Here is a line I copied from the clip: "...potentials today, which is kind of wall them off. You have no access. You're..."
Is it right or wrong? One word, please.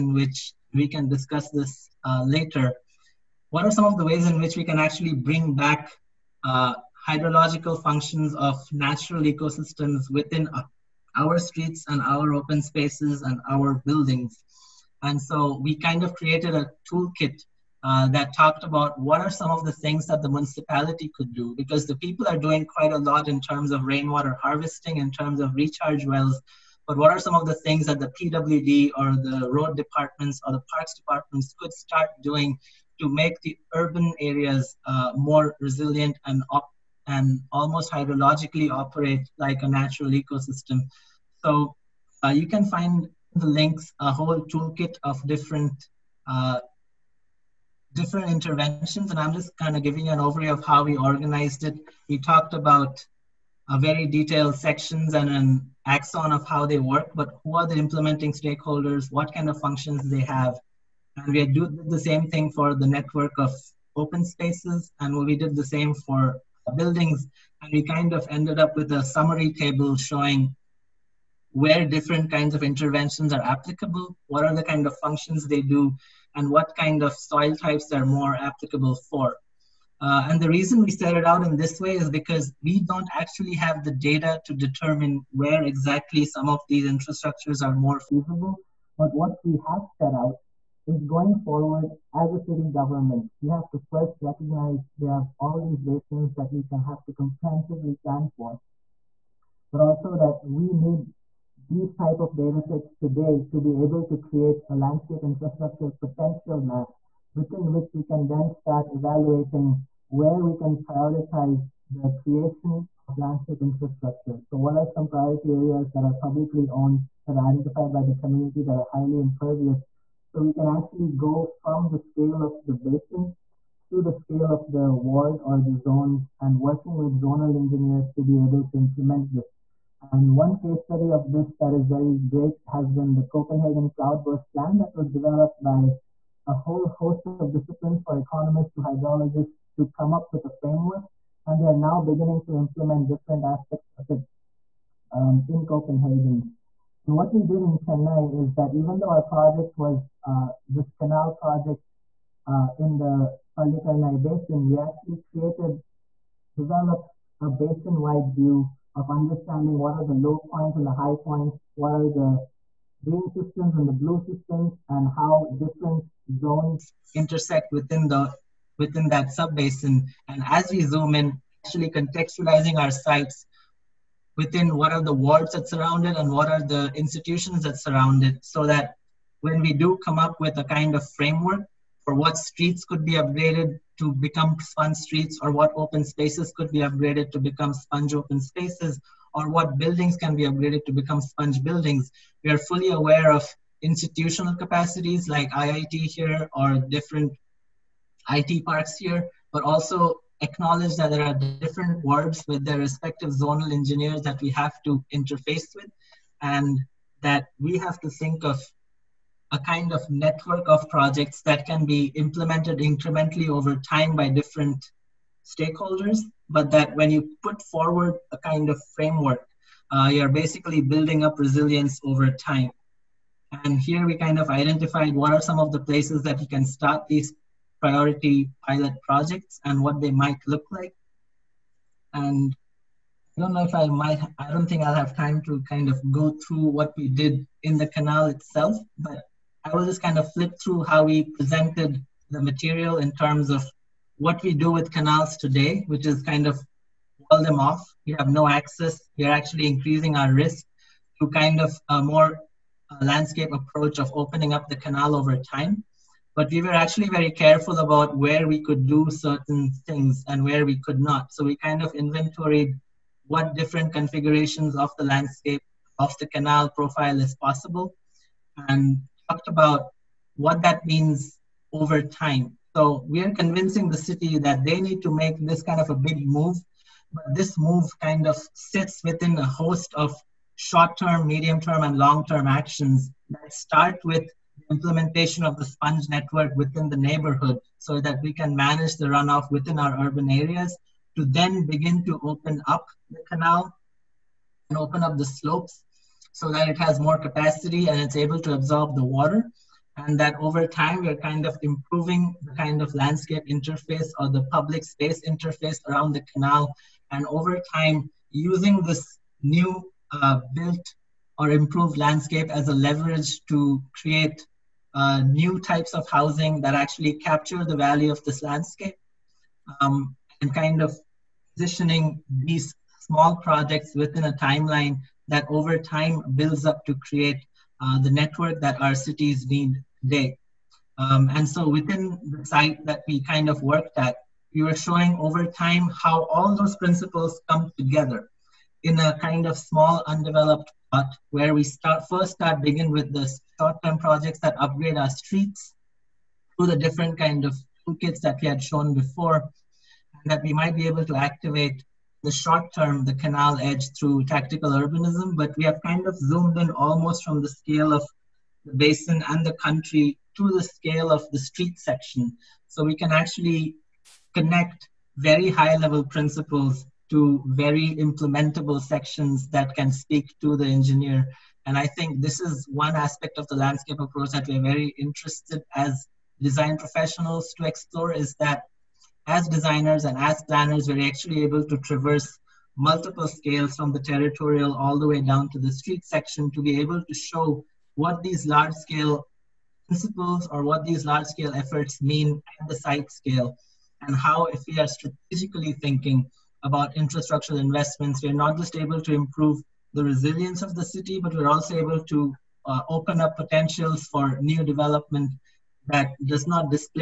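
wrong.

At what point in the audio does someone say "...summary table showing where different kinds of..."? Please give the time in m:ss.
1:09.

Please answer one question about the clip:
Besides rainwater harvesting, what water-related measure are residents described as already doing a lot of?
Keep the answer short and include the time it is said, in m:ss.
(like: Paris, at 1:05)
Recharge wells, at 0:25.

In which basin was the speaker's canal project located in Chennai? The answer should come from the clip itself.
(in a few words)
Pallikaranai Basin.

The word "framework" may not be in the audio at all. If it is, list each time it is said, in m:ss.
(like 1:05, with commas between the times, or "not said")
2:20, 3:01, 3:38.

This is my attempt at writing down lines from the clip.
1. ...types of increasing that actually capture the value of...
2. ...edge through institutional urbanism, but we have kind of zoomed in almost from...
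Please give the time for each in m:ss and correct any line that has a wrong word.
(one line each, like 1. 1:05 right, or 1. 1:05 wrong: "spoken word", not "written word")
1. 5:15 wrong: "housing", not "increasing"
2. 5:53 wrong: "tactical", not "institutional".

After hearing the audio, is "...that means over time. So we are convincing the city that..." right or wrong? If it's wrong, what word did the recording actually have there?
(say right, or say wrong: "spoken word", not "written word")
right.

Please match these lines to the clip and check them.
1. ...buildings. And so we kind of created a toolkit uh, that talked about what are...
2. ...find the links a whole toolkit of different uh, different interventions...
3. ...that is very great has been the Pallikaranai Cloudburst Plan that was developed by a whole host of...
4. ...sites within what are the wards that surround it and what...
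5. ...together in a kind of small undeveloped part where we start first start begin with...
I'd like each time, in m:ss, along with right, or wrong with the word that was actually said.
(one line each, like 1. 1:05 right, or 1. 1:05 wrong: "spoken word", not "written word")
1. 0:13 right
2. 0:42 right
3. 2:11 wrong: "Copenhagen", not "Pallikaranai"
4. 2:52 right
5. 5:37 right.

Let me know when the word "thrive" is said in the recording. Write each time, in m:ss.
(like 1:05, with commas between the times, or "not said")
not said.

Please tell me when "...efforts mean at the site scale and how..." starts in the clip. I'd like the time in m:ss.
6:31.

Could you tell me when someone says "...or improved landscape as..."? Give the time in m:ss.
5:11.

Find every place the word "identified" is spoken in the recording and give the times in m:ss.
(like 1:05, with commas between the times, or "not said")
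1:57, 3:44.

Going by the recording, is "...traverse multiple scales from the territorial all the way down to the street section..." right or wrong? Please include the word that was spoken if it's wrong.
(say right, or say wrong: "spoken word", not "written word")
right.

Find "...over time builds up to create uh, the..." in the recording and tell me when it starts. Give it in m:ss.
5:25.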